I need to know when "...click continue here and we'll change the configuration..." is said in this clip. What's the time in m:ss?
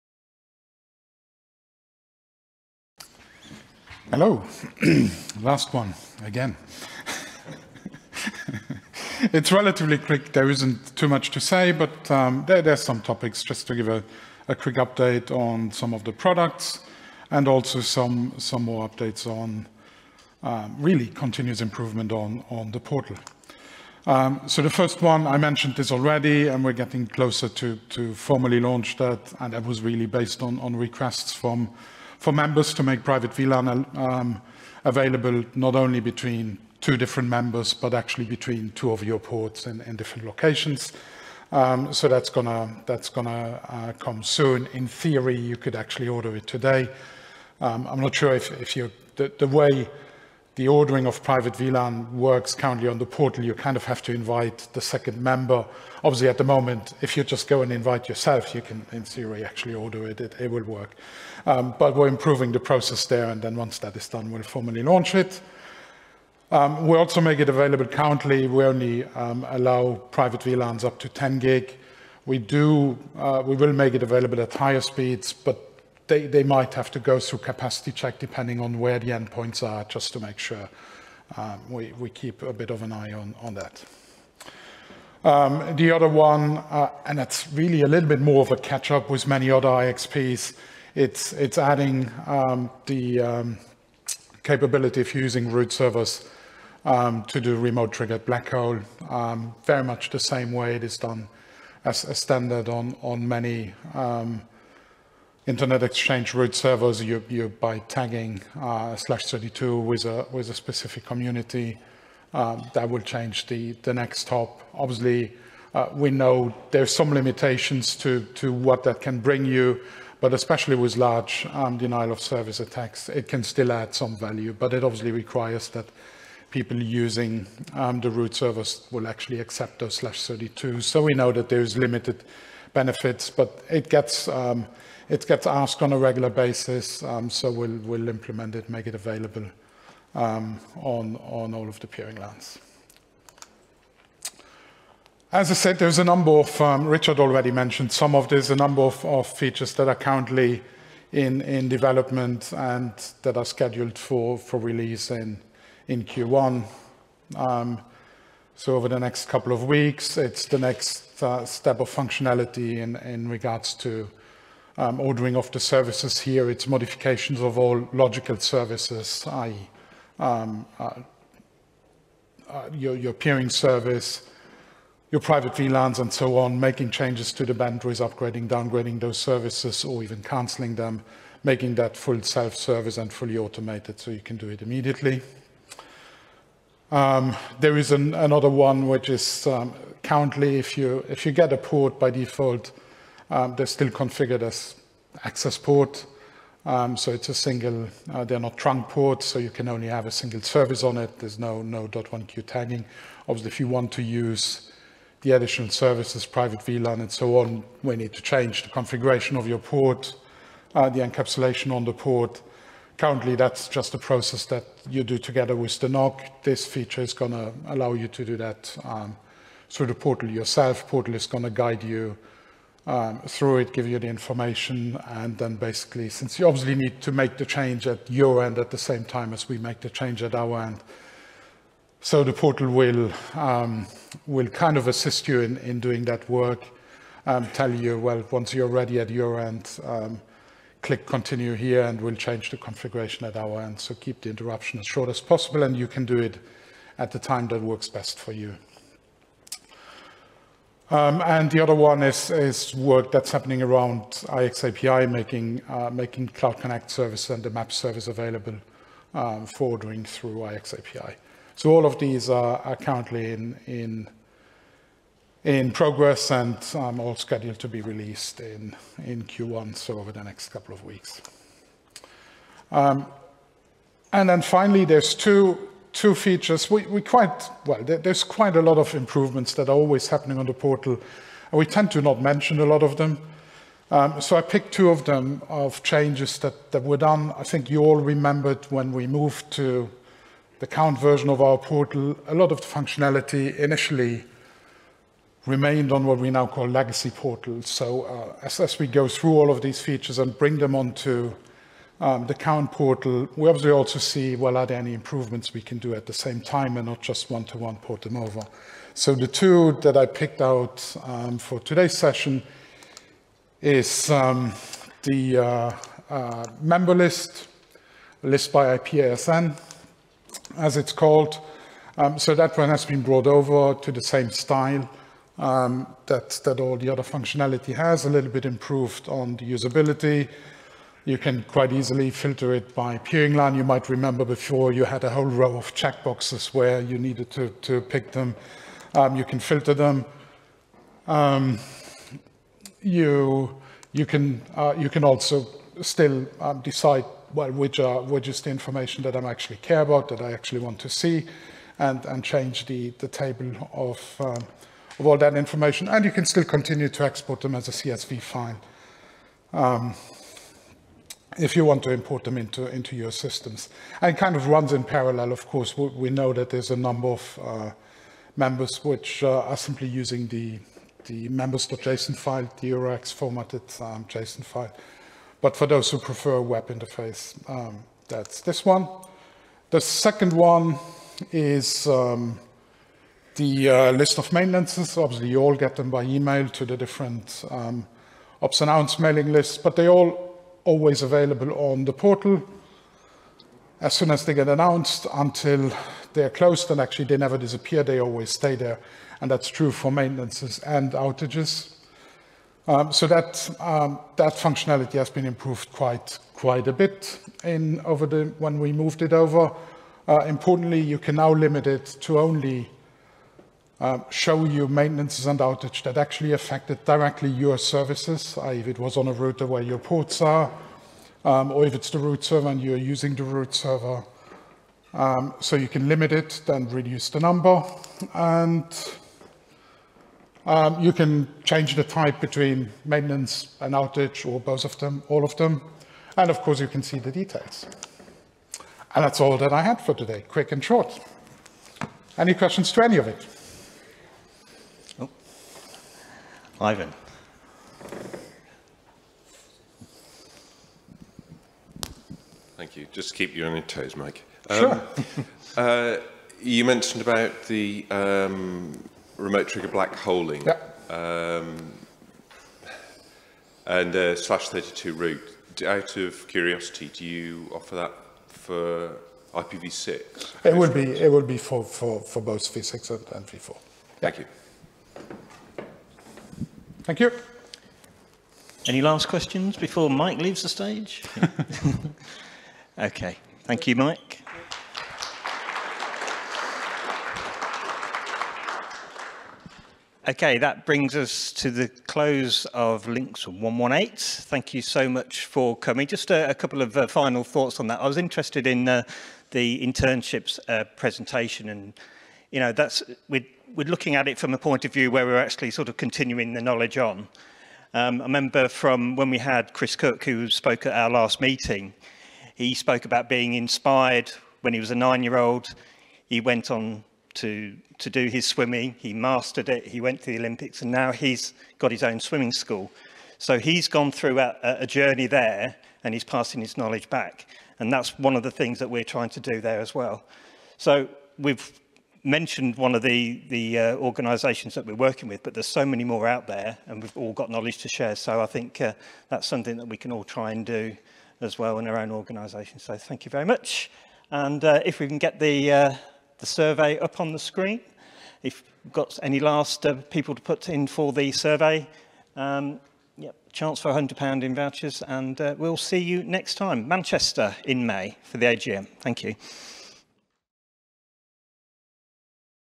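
4:00.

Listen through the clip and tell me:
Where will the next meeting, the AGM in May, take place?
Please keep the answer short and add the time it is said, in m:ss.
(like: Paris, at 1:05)
Manchester, at 9:16.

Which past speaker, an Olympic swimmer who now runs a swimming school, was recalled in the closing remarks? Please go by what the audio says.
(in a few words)
Chris Cook.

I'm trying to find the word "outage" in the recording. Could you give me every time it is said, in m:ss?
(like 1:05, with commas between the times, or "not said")
6:40, 6:55, 7:13.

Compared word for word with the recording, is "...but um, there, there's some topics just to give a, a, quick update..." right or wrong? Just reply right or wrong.
right.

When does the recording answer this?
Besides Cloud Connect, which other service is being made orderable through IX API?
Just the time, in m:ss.
4:17.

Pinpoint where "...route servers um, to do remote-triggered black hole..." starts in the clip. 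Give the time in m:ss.
1:35.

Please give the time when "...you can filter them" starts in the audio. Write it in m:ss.
5:39.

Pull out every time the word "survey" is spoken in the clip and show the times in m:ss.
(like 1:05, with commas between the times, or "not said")
9:06, 9:11.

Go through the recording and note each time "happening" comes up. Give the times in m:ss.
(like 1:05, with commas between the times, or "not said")
4:13, 4:40.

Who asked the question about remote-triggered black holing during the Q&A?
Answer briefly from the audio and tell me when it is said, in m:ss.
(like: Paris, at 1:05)
Ivan, at 7:26.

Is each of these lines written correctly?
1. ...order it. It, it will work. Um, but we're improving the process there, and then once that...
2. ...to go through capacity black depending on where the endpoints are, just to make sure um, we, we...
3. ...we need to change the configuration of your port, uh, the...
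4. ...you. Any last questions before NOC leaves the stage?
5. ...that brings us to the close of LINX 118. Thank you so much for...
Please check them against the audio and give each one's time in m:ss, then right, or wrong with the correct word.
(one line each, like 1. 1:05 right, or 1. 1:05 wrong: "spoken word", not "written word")
1. 0:59 right
2. 1:16 wrong: "check", not "black"
3. 3:27 right
4. 7:56 wrong: "Mike", not "NOC"
5. 8:10 right.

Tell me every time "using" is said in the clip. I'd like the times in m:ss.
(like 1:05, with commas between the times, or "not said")
1:35, 2:06, 6:09, 7:02.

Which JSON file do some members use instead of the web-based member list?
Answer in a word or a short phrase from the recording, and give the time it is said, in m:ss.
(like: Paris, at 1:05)
members.json, at 6:11.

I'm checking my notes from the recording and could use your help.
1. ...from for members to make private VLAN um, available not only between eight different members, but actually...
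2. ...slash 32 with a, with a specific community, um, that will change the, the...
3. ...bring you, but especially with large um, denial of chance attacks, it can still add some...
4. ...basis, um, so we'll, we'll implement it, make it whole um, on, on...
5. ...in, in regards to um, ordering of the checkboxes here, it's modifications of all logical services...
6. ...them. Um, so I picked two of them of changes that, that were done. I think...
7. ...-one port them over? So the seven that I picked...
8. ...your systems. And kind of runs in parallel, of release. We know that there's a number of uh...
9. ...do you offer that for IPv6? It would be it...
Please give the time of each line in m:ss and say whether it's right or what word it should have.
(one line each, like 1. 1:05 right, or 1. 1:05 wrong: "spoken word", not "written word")
1. 0:31 wrong: "two", not "eight"
2. 1:48 right
3. 1:59 wrong: "service", not "chance"
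4. 2:16 wrong: "available", not "whole"
5. 2:42 wrong: "services", not "checkboxes"
6. 4:42 right
7. 5:07 wrong: "two", not "seven"
8. 6:02 wrong: "course", not "release"
9. 7:46 right.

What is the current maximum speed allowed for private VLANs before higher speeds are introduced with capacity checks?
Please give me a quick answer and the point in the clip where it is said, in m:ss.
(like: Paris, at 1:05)
10 gig, at 1:11.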